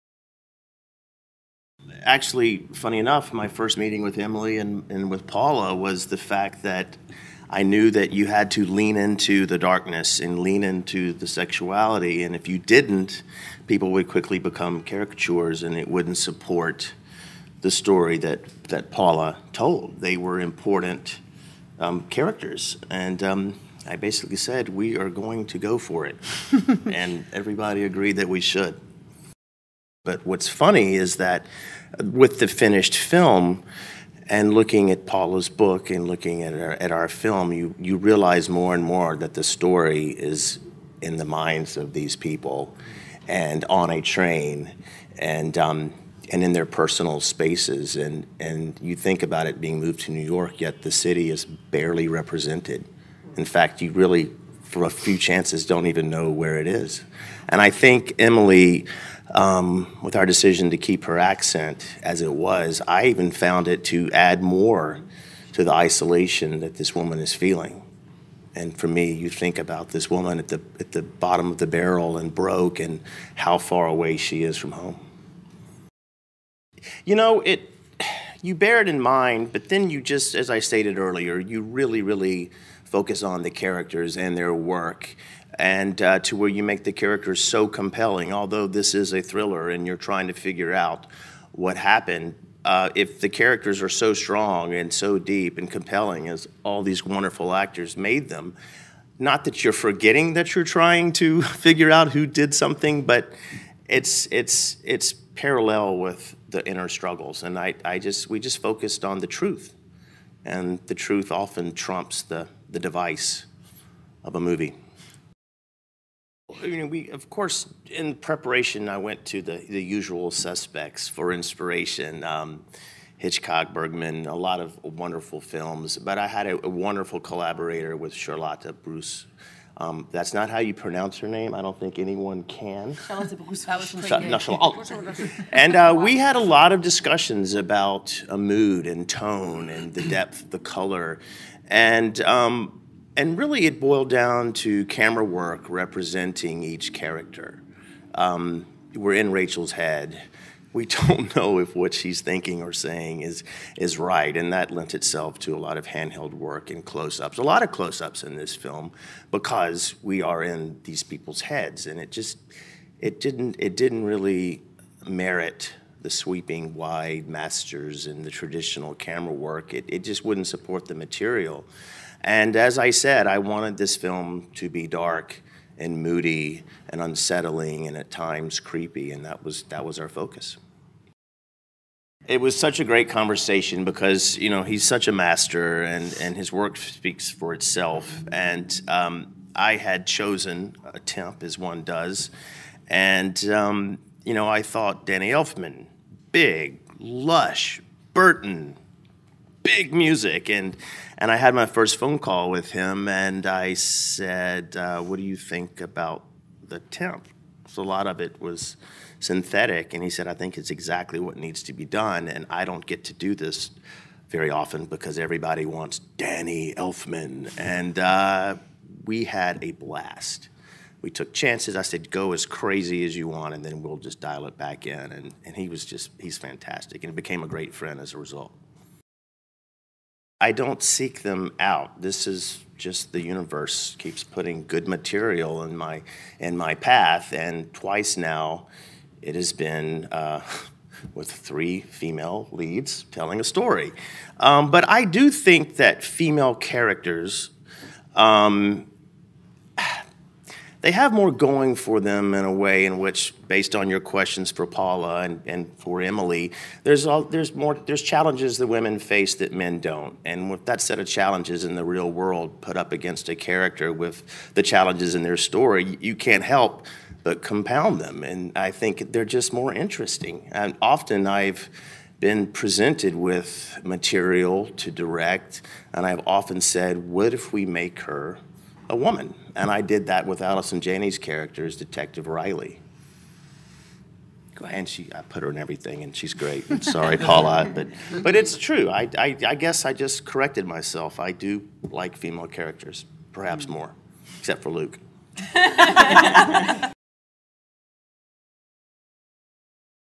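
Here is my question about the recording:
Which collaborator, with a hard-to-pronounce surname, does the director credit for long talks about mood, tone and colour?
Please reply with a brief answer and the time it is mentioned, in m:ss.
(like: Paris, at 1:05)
Charlotta Bruus, at 2:08.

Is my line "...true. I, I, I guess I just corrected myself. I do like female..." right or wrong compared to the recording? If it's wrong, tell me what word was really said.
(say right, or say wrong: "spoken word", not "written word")
right.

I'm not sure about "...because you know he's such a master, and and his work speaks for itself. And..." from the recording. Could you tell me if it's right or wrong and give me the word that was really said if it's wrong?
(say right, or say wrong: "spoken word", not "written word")
right.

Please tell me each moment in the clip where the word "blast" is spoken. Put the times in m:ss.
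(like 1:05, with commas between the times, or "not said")
3:39.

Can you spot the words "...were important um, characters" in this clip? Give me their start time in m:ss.
0:20.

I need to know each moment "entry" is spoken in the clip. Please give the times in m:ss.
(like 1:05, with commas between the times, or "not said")
not said.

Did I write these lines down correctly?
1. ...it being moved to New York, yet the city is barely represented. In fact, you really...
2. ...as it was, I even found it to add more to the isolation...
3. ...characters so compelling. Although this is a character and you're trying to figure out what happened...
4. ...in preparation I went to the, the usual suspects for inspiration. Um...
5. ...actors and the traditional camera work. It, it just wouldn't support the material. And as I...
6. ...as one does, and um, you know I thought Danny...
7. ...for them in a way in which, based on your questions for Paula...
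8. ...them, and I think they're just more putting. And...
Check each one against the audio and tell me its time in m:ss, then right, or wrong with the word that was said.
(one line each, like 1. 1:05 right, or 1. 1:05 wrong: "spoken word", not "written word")
1. 0:49 right
2. 1:02 right
3. 1:26 wrong: "thriller", not "character"
4. 1:57 right
5. 2:47 wrong: "masters", not "actors"
6. 3:11 right
7. 4:11 right
8. 4:28 wrong: "interesting", not "putting".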